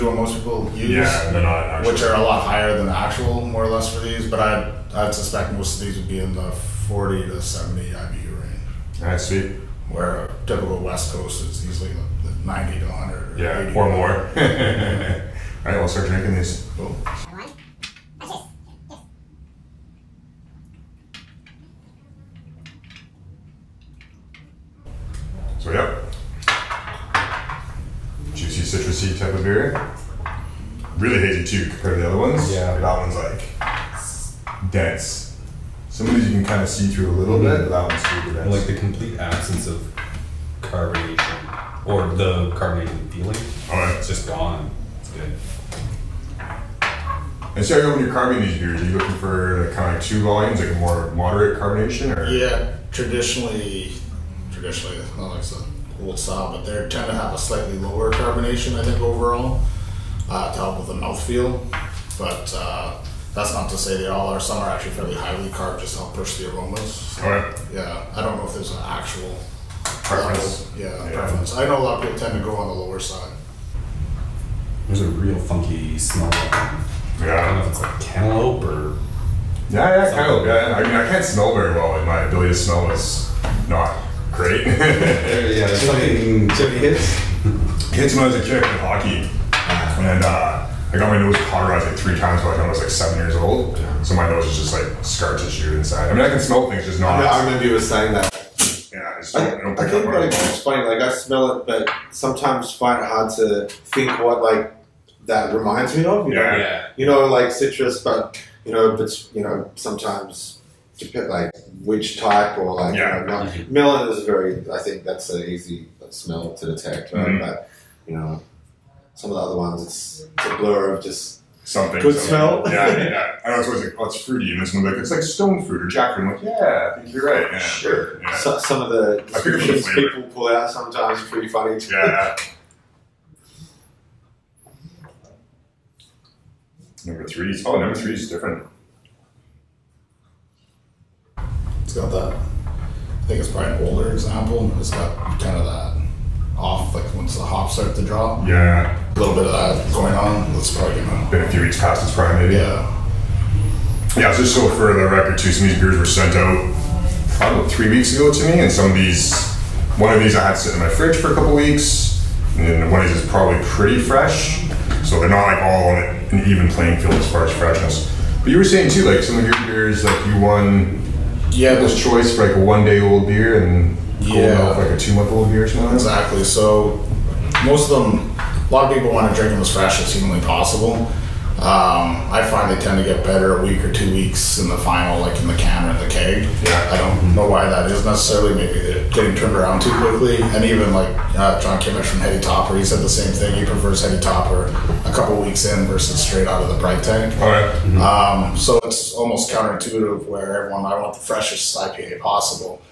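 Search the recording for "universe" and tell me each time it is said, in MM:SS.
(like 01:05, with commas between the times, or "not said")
not said.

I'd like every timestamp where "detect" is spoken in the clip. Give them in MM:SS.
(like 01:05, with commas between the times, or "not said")
01:56.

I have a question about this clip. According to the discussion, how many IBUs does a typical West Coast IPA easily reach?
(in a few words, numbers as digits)
90 to 100.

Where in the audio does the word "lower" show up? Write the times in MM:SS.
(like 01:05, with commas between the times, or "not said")
00:57, 01:12.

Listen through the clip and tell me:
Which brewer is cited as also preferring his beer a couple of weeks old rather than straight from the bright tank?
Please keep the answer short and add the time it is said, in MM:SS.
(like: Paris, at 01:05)
John Kimmich, at 03:11.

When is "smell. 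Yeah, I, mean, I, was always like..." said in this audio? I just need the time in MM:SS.
02:02.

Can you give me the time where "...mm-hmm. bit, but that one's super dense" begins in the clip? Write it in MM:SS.
00:37.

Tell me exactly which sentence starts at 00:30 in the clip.
Really hazy too compared to the other ones.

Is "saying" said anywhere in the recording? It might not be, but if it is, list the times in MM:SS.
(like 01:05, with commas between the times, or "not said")
01:37, 02:48.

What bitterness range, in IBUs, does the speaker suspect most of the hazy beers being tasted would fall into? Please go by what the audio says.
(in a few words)
40 to 70 IBU.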